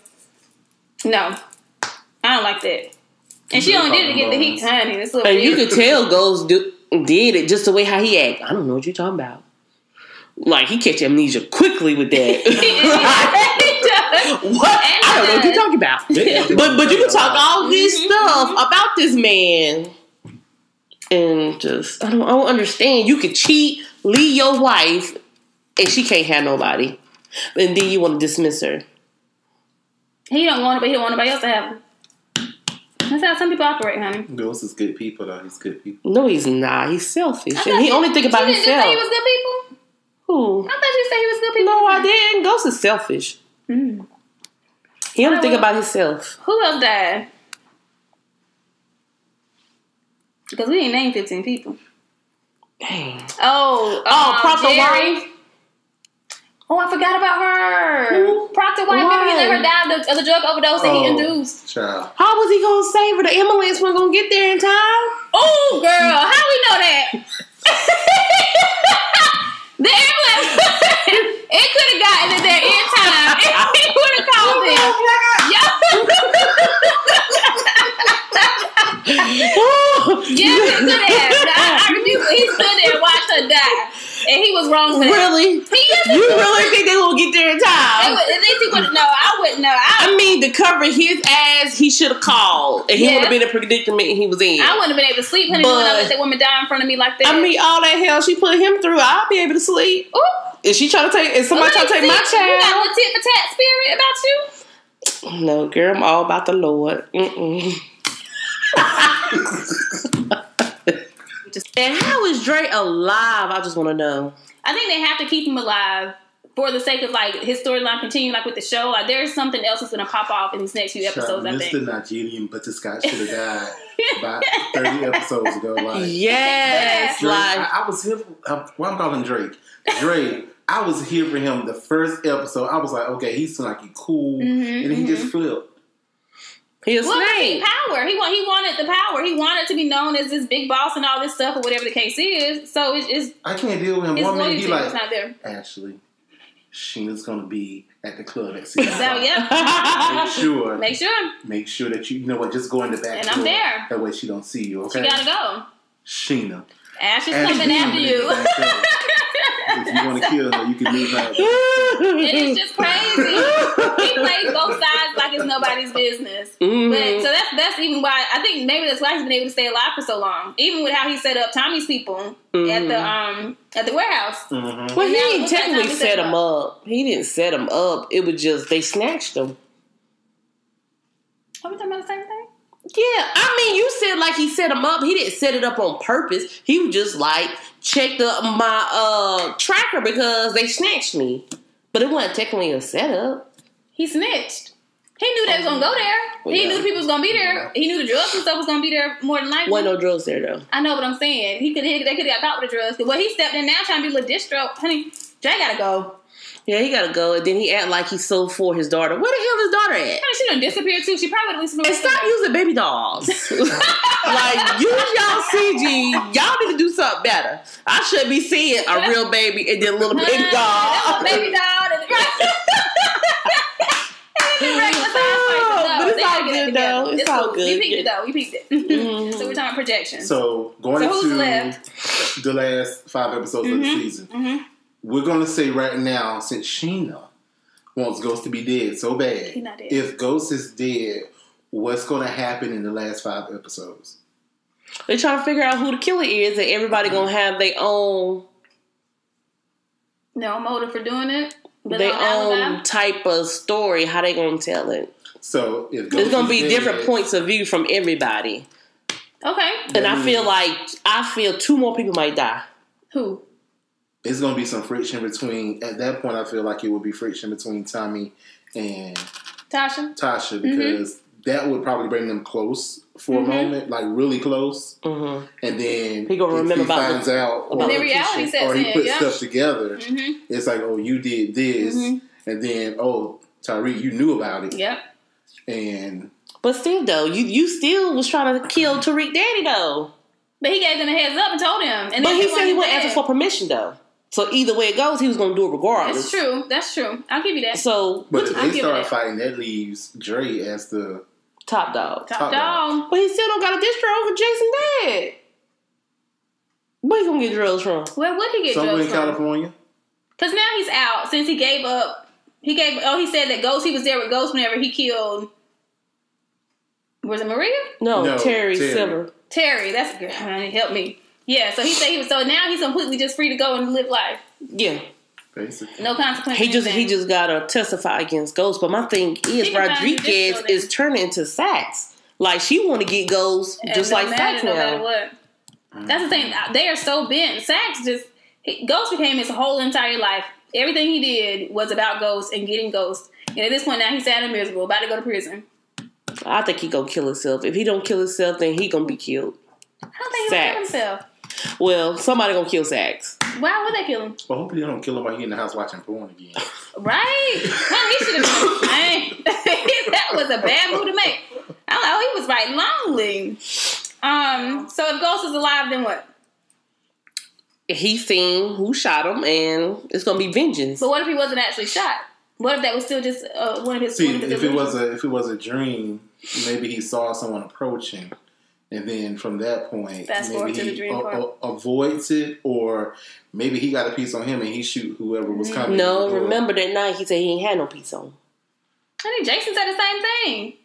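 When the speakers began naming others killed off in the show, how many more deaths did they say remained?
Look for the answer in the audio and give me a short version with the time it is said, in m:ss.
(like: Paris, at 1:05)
15, at 0:51.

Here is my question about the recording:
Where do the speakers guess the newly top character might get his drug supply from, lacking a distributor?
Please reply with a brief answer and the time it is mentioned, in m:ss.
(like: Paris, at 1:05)
California, at 5:09.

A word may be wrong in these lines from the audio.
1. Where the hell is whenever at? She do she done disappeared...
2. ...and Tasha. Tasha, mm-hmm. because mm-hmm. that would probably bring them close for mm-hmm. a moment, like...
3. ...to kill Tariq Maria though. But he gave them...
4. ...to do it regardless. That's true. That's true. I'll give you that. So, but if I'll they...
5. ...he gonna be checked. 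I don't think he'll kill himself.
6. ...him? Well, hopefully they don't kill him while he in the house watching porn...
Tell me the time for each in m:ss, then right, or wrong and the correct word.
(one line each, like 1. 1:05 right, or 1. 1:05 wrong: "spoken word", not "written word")
1. 3:29 wrong: "daughter", not "whenever"
2. 4:28 right
3. 4:48 wrong: "Daddy", not "Maria"
4. 4:55 right
5. 5:48 wrong: "killed", not "checked"
6. 5:54 right.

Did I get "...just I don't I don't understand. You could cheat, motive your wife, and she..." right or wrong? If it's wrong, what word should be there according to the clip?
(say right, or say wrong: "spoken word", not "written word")
wrong: "leave", not "motive".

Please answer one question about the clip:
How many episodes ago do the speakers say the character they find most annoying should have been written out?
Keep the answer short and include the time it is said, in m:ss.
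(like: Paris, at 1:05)
30, at 2:04.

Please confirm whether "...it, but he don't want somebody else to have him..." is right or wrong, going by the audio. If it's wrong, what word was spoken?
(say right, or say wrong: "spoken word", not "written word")
wrong: "anybody", not "somebody".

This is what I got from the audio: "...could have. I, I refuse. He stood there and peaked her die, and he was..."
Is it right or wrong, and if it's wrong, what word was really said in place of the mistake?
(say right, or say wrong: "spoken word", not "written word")
wrong: "watched", not "peaked".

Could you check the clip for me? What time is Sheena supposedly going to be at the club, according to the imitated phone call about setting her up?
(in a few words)
6.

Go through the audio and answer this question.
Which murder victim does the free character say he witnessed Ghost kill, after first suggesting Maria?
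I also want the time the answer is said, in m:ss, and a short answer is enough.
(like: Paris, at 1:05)
Terry Silver, at 5:18.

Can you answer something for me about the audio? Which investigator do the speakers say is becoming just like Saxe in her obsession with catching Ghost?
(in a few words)
Rodriguez.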